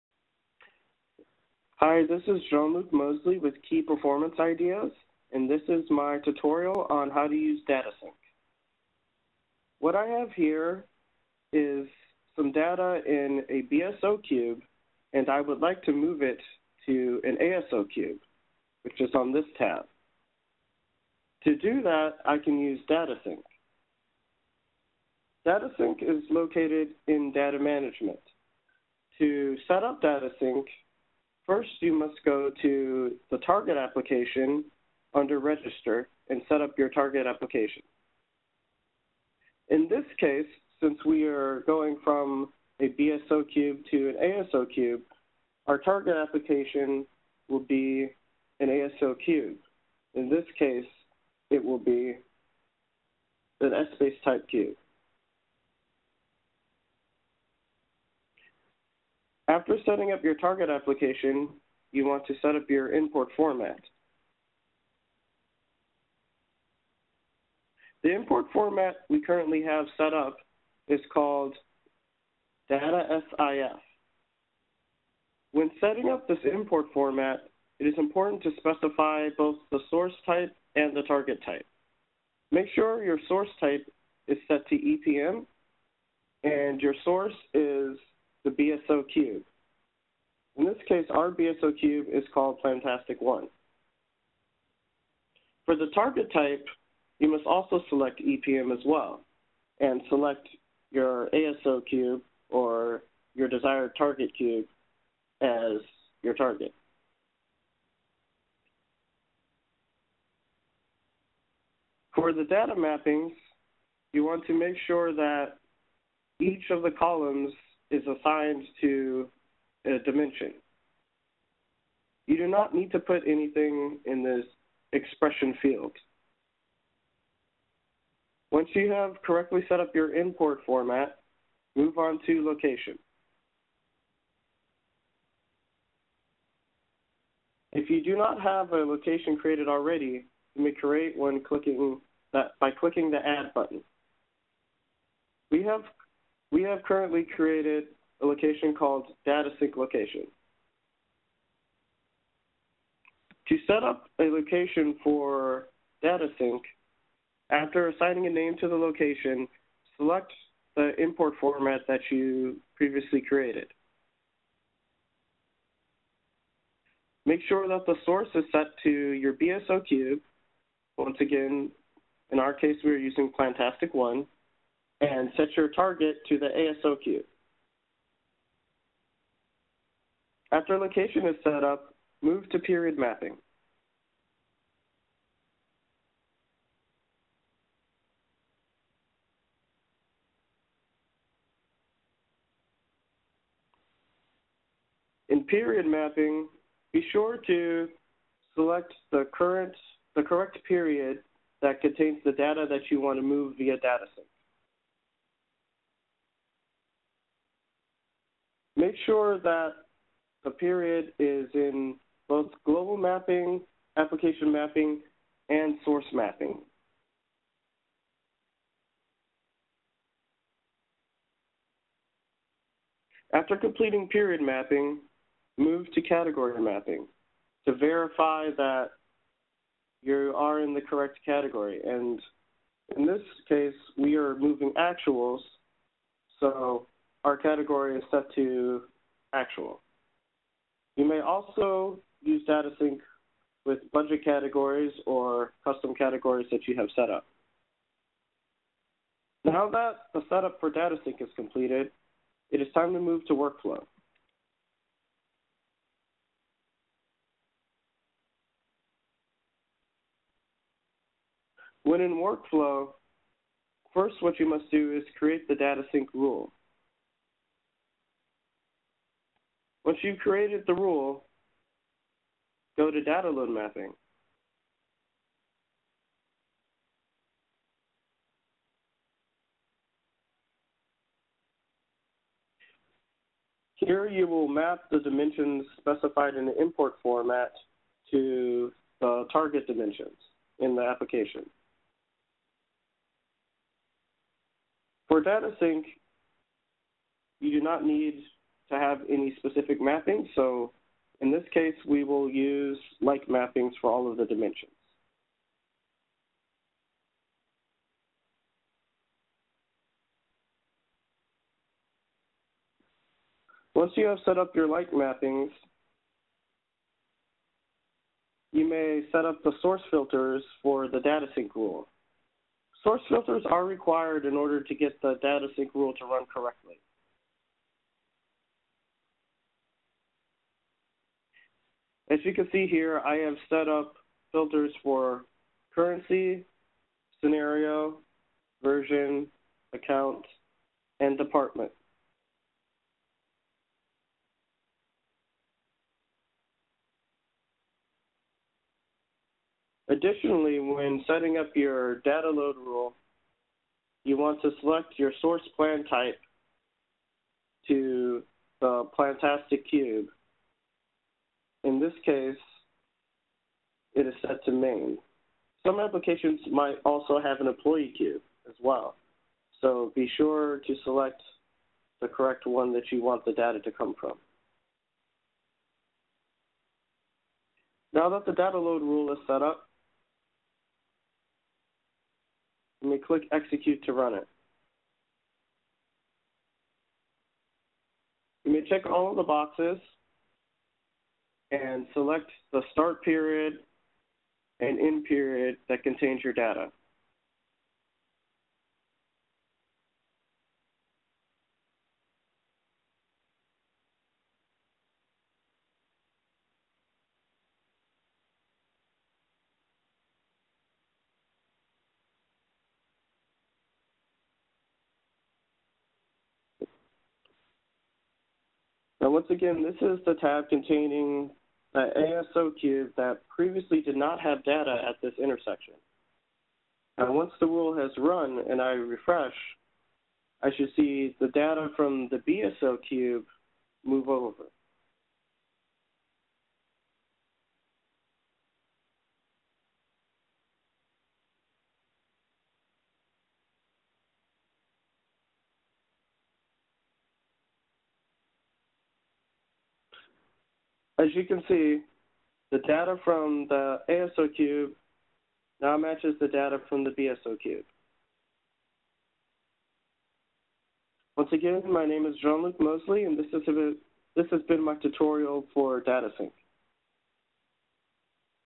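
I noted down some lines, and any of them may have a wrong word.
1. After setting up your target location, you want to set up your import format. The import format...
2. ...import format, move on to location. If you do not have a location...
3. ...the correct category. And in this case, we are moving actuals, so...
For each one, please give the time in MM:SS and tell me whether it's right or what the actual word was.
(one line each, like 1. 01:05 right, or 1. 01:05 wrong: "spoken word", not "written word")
1. 00:59 wrong: "application", not "location"
2. 02:10 right
3. 03:50 right.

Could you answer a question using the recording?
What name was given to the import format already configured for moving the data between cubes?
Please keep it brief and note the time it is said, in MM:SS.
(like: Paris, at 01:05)
Data SIF, at 01:12.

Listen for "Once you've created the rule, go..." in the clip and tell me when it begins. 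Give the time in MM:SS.
04:29.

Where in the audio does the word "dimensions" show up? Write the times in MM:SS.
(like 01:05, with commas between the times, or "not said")
01:59, 04:44, 04:49, 05:04.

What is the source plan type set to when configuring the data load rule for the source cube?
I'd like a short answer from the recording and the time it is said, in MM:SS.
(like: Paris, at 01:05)
Main, at 06:04.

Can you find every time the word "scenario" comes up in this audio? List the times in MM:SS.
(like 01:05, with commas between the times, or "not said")
05:37.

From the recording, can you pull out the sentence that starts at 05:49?
Additionally, when setting up your data load rule, you want to select your source plan type to the Plantastic Cube.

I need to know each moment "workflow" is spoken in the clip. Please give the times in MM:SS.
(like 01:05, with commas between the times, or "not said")
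04:13, 04:22.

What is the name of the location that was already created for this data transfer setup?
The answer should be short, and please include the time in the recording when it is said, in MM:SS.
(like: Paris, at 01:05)
DataSync location, at 02:29.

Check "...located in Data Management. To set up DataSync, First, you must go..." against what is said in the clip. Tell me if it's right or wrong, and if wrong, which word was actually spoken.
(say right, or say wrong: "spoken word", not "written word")
right.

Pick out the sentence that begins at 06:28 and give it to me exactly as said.
You may check all of the boxes and select the start period and end period that contains your data.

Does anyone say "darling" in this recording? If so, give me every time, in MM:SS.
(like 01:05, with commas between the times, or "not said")
not said.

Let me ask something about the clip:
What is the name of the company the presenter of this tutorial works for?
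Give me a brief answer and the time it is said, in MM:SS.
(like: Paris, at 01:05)
Key Performance Ideas, at 00:03.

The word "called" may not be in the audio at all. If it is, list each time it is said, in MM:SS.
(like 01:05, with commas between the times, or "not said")
01:11, 01:32, 02:28.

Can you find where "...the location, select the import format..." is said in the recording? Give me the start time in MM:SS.
02:38.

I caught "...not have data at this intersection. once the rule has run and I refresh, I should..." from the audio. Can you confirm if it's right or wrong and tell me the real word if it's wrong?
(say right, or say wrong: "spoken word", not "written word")
right.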